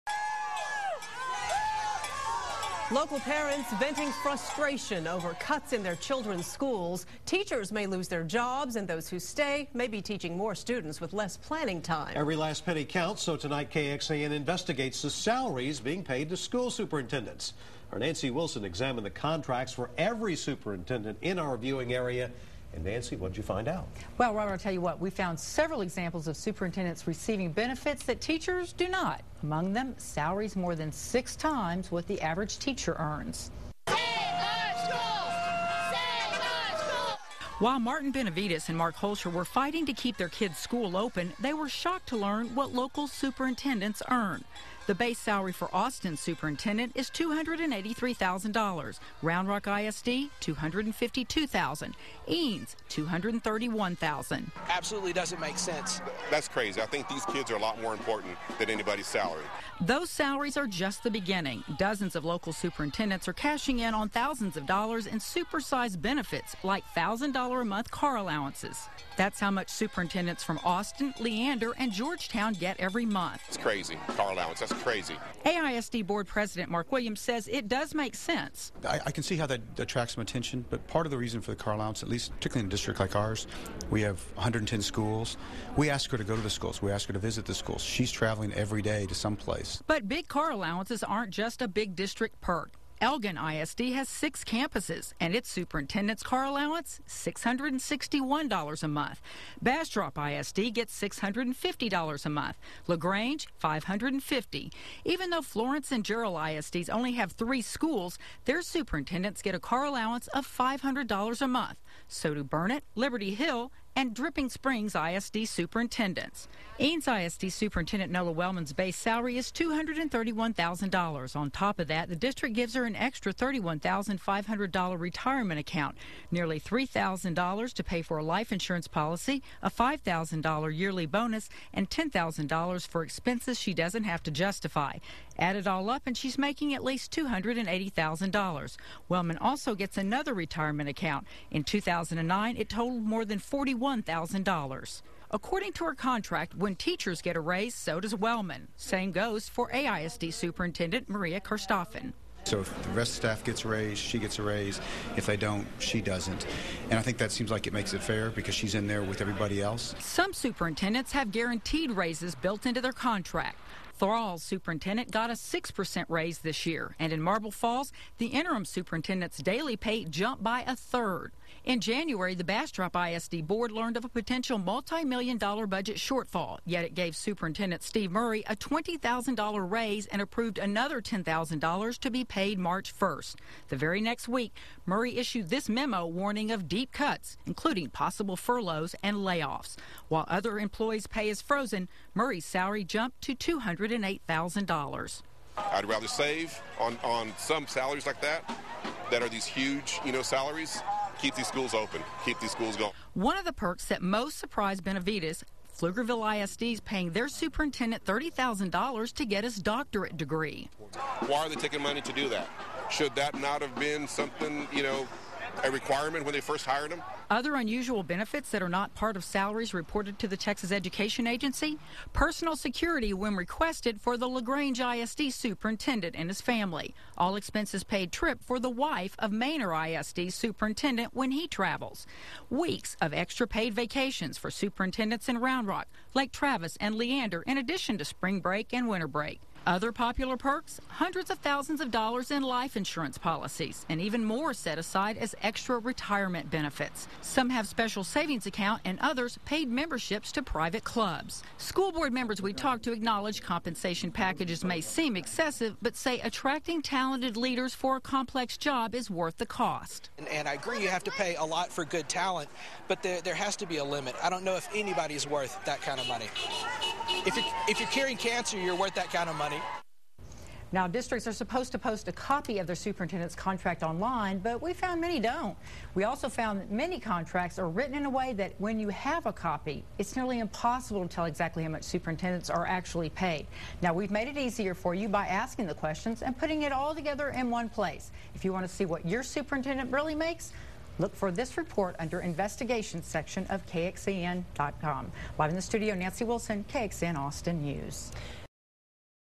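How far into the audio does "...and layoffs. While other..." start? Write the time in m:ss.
3:09.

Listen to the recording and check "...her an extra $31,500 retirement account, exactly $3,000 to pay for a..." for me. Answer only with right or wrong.
wrong.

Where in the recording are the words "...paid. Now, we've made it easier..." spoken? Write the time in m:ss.
4:43.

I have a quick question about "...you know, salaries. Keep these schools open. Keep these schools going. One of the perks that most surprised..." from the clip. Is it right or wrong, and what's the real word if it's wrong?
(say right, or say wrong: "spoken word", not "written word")
right.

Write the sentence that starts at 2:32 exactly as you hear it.
So if the rest of the staff gets a raise, she gets a raise.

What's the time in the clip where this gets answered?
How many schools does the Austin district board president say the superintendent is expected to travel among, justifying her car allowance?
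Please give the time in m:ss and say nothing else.
1:24.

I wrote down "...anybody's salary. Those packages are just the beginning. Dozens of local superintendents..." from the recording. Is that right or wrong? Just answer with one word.
wrong.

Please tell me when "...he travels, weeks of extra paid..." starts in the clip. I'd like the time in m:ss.
3:51.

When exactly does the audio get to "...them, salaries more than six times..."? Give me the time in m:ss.
0:29.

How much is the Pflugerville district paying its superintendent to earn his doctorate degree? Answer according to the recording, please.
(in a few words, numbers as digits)
$30,000.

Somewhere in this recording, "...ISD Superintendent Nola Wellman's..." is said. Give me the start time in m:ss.
1:57.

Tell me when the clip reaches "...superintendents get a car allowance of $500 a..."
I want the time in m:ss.
1:48.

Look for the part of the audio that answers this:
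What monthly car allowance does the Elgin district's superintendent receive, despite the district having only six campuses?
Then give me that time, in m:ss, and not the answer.
1:37.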